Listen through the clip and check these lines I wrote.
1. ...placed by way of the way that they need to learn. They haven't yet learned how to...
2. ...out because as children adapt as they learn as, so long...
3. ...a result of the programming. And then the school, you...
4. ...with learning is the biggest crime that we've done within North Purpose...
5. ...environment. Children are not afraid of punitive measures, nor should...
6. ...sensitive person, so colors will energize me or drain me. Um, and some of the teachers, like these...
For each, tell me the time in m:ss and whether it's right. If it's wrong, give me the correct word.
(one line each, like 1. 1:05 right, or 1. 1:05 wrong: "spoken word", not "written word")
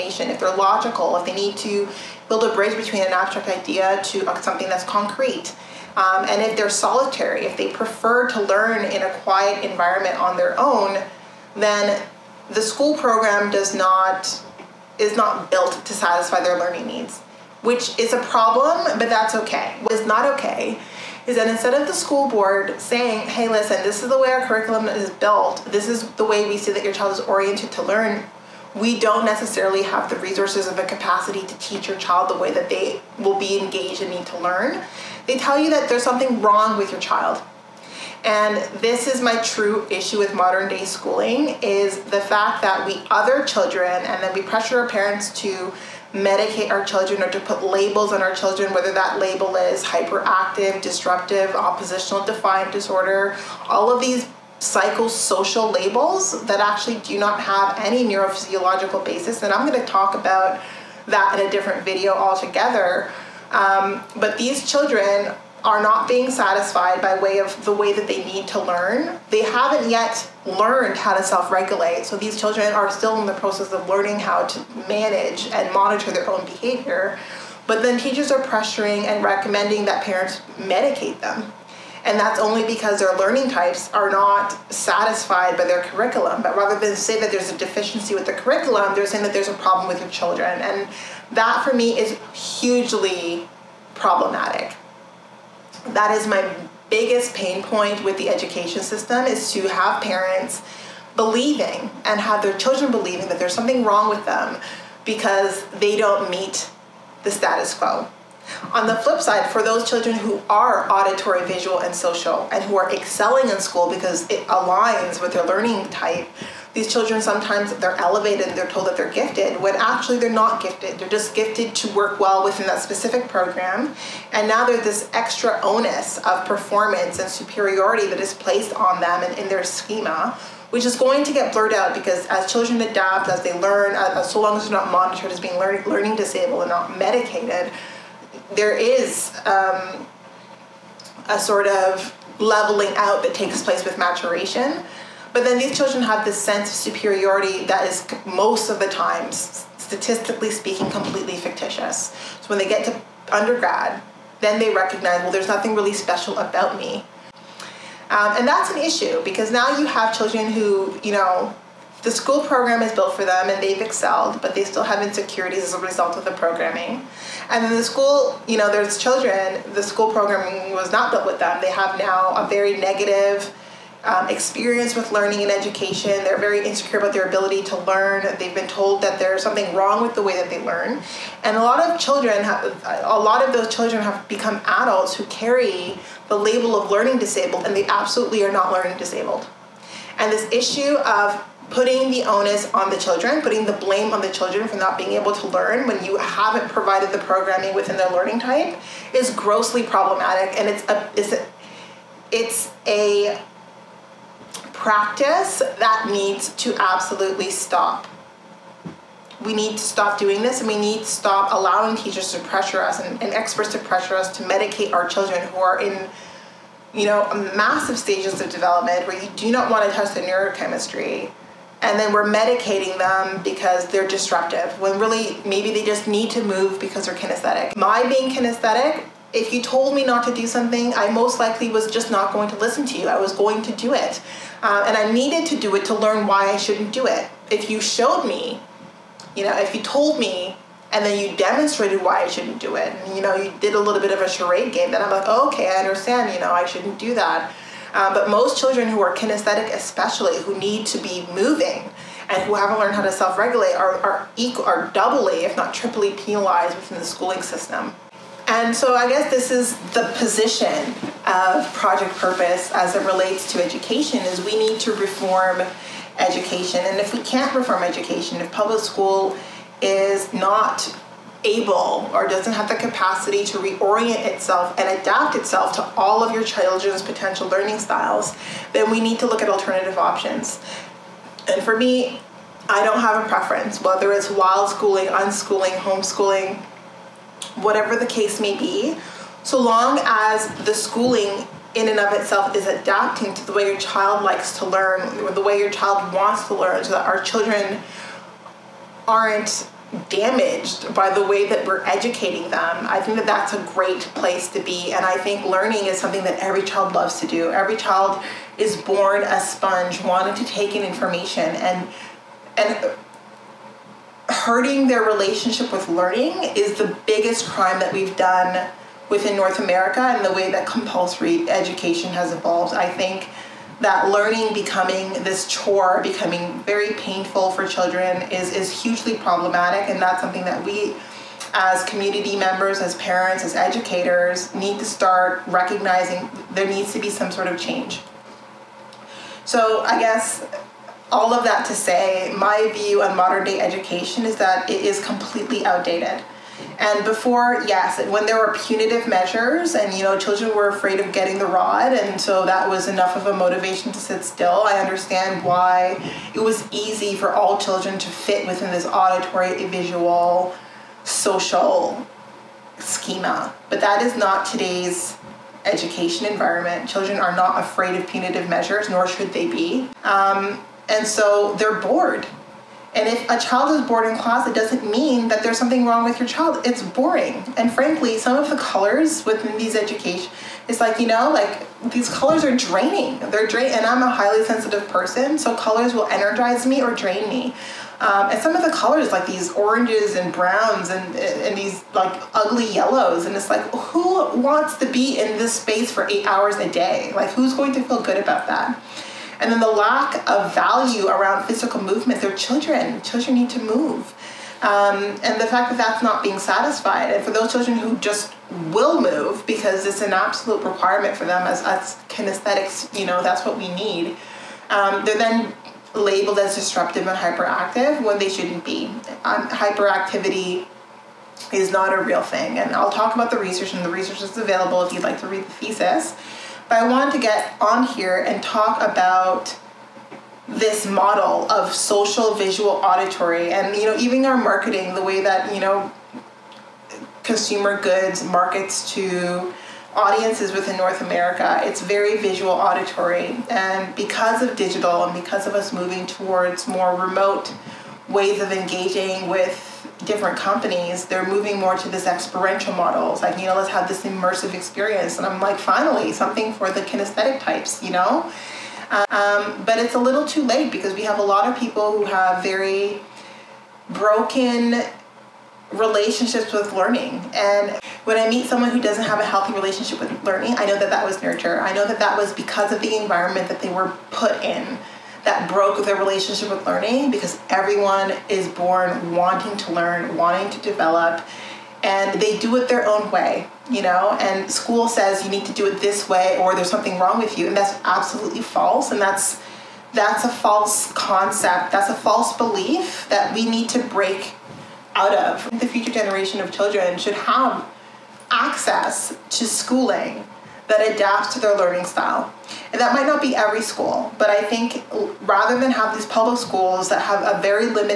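1. 1:06 wrong: "satisfied", not "placed"
2. 2:11 right
3. 2:45 right
4. 5:15 wrong: "America", not "Purpose"
5. 6:06 right
6. 6:24 wrong: "colors", not "teachers".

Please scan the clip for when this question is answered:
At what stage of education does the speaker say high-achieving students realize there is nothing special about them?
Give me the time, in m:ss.
2:33.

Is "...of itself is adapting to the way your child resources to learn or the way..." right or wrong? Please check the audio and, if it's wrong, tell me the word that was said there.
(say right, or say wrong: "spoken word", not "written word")
wrong: "likes", not "resources".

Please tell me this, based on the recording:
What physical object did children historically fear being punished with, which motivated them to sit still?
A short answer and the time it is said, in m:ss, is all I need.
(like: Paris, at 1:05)
the rod, at 5:51.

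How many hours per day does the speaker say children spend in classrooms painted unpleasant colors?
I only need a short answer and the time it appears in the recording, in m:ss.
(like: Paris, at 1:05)
8, at 6:36.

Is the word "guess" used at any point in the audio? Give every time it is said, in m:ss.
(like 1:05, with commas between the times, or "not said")
4:19, 5:39.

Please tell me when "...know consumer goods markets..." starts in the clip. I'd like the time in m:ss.
7:15.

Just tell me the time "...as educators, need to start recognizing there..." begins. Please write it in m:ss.
5:33.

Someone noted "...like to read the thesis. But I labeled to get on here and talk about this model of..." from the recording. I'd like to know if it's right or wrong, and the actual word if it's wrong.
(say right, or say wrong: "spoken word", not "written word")
wrong: "wanted", not "labeled".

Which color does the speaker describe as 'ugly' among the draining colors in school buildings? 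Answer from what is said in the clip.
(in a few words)
yellows.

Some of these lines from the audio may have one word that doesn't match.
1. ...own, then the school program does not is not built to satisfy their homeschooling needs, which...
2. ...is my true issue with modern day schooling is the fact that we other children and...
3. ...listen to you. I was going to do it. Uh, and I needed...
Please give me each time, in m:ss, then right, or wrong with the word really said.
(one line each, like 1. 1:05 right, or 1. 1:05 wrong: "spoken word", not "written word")
1. 0:10 wrong: "learning", not "homeschooling"
2. 0:39 right
3. 3:52 right.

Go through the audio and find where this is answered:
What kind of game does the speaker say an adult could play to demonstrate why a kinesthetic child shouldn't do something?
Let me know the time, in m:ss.
4:04.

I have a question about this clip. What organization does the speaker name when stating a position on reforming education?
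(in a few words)
Project Purpose.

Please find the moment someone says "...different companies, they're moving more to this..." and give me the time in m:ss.
7:30.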